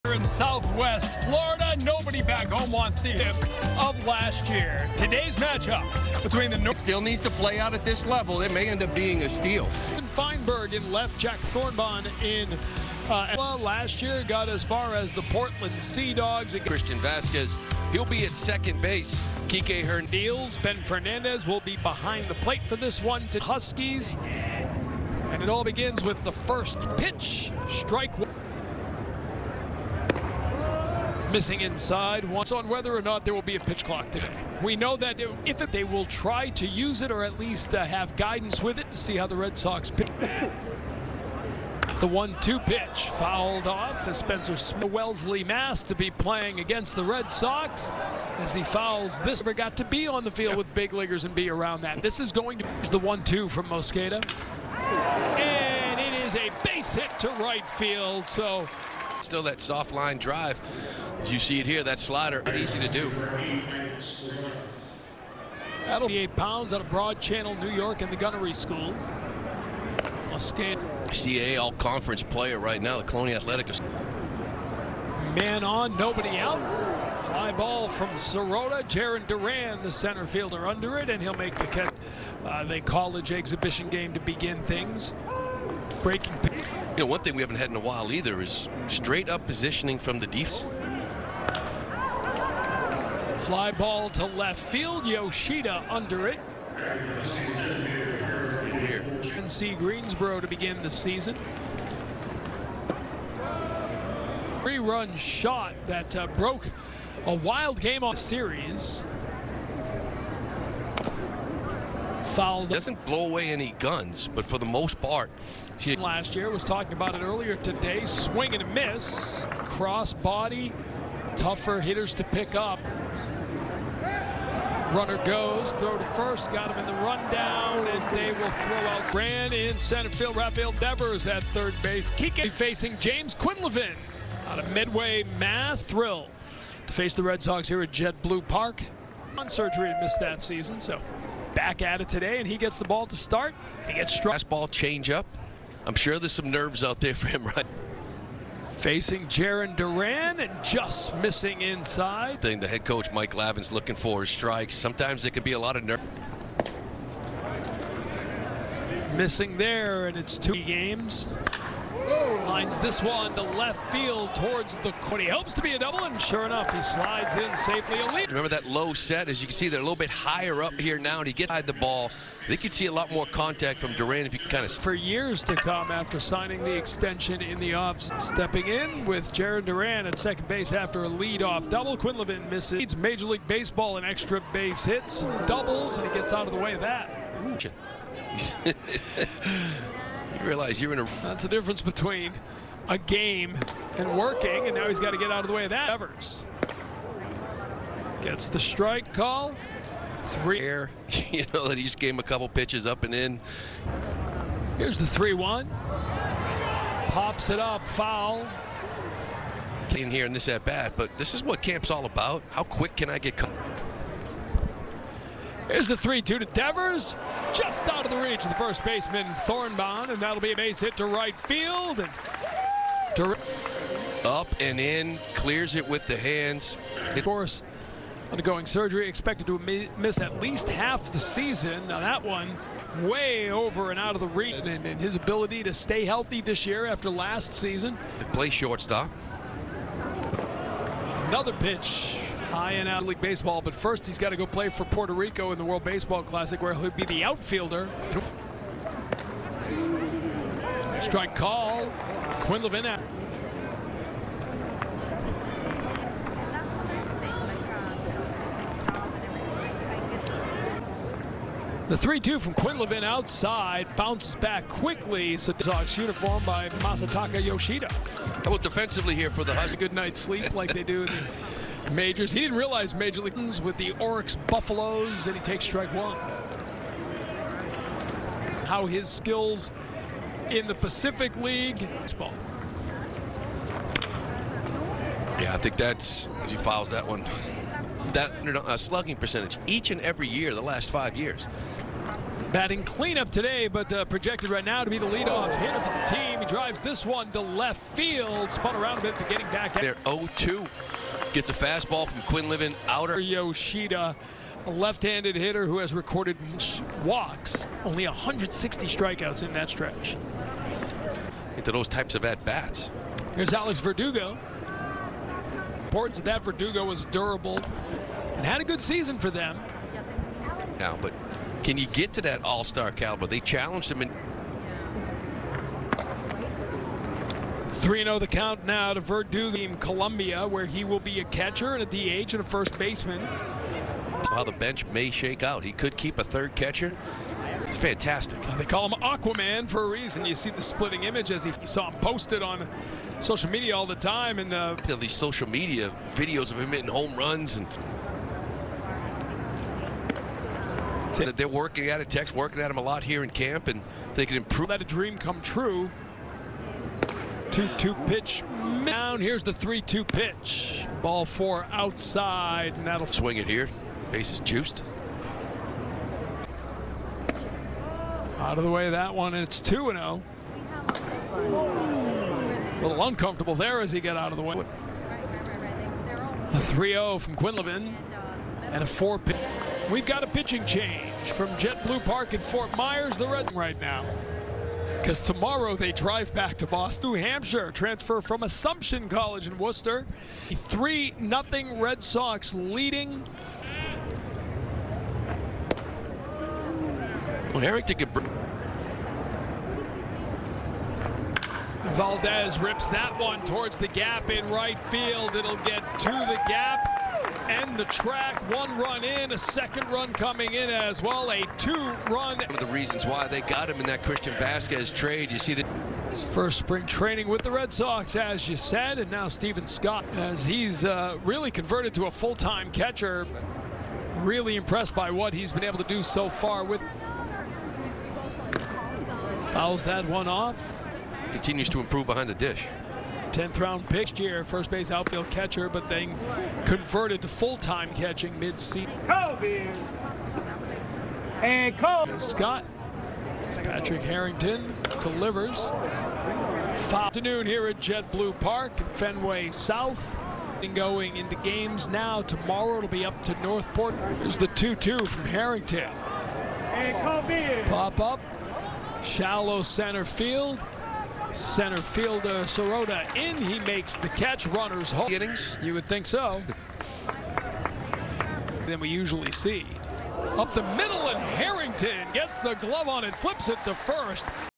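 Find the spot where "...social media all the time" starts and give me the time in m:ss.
5:43.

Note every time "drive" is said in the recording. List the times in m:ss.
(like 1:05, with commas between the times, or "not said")
1:00, 4:56, 6:25.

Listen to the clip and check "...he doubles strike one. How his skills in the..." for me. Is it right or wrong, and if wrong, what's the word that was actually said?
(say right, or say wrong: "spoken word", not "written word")
wrong: "takes", not "doubles".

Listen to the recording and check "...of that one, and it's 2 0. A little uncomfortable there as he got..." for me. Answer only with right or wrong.
right.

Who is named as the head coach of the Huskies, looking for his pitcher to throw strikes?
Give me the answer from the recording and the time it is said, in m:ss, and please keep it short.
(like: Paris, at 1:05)
Mike Glavine, at 2:33.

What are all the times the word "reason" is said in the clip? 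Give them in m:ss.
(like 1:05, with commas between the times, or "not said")
5:39, 6:52.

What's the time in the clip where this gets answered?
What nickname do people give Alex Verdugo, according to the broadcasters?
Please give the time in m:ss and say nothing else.
5:39.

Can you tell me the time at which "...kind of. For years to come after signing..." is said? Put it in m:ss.
2:54.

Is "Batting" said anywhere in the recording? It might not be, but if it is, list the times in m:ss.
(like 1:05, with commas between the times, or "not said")
4:52.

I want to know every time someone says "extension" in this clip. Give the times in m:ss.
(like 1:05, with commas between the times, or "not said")
2:56.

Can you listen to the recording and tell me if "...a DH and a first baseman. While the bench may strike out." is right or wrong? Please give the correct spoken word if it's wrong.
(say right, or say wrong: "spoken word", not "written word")
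wrong: "shake", not "strike".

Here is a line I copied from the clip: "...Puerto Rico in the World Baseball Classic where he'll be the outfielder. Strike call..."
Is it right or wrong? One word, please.
right.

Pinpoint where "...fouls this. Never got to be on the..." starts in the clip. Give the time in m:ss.
0:48.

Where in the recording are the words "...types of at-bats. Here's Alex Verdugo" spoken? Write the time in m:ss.
5:11.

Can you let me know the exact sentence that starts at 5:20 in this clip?
Now, but can you get to that all-star caliber?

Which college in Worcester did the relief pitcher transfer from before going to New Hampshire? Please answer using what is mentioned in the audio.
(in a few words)
Assumption College.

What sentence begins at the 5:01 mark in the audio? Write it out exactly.
Gets a fastball from Quinlivan outer.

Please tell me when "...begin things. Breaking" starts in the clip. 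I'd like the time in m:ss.
1:24.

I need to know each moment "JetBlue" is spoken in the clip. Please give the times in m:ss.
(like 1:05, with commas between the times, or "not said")
2:17, 6:21, 7:27.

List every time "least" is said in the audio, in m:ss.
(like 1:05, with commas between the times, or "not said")
0:37, 3:50.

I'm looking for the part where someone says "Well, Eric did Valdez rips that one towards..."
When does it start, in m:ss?
6:37.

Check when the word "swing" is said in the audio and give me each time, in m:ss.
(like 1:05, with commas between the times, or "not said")
1:58, 6:03.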